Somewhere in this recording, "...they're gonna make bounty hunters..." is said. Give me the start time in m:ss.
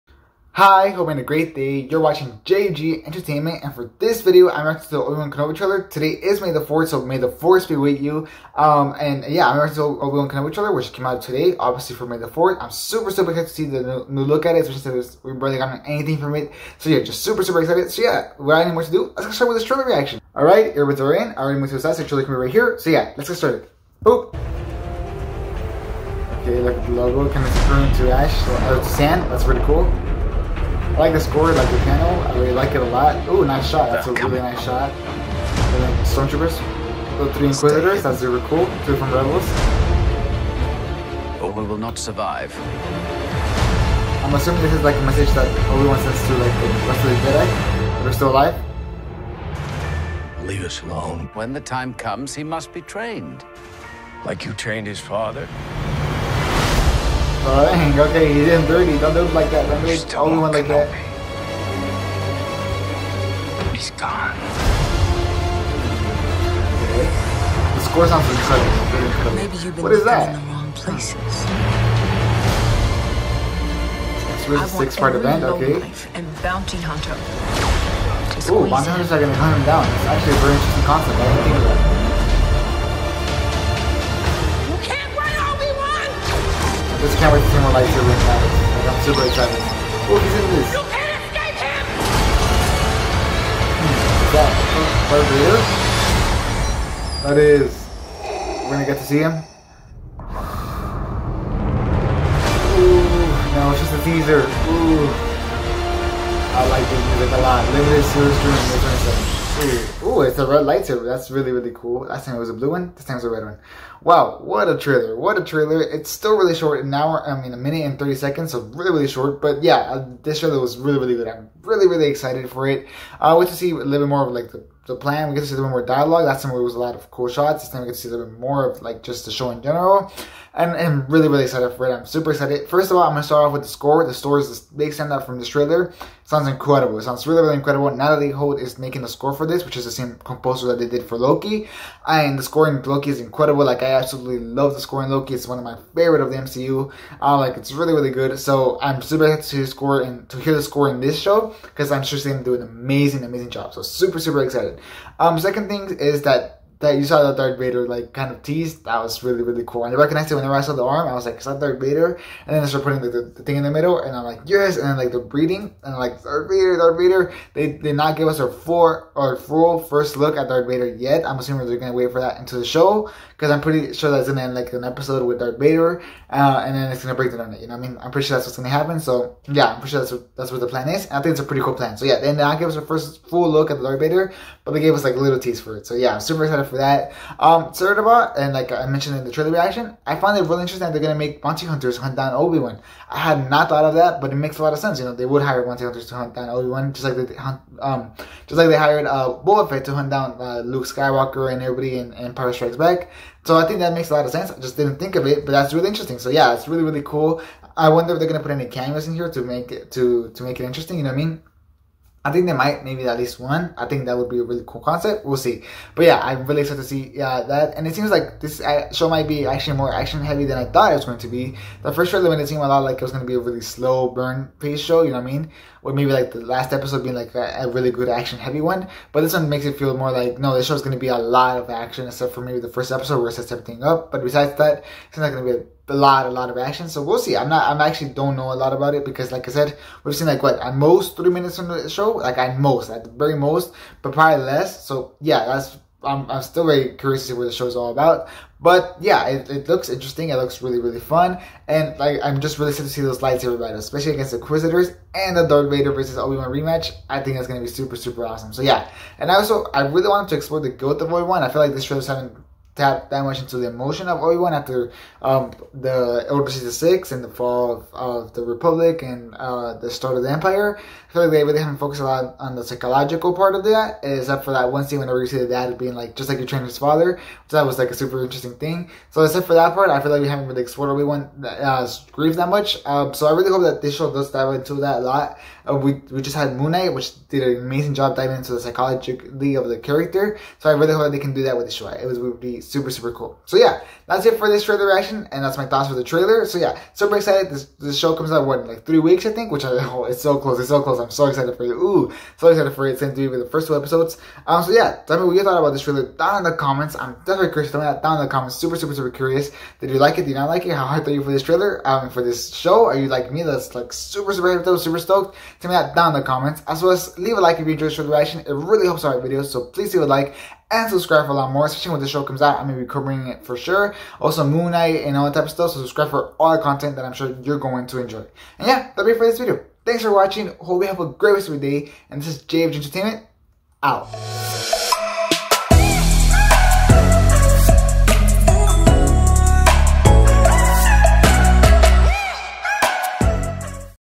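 3:10.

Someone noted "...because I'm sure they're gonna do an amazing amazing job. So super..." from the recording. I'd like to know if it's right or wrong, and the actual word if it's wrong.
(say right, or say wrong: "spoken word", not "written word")
right.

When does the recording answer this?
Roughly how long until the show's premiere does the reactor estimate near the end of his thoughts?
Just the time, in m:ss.
4:58.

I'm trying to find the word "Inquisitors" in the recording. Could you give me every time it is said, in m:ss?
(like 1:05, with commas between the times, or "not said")
0:37, 4:14.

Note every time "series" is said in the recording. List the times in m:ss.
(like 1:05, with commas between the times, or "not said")
1:48.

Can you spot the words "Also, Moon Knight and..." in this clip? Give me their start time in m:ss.
5:24.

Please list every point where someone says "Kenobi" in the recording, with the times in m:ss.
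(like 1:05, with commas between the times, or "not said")
0:05, 0:10.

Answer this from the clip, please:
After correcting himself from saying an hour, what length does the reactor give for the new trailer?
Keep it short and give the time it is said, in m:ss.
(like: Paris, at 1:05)
1 minute 30 seconds, at 1:57.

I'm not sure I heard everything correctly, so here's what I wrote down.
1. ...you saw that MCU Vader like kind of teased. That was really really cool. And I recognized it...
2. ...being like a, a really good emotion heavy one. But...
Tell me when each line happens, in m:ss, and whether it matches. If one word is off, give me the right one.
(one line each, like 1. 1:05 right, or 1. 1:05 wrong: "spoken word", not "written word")
1. 2:36 wrong: "Darth", not "MCU"
2. 3:47 wrong: "action", not "emotion".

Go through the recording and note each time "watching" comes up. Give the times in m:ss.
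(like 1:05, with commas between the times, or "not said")
0:02, 5:30.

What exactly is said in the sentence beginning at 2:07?
This time we get to see a little bit more of like just the show in general.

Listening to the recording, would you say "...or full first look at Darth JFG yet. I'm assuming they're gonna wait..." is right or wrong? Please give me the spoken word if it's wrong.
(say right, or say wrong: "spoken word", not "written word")
wrong: "Vader", not "JFG".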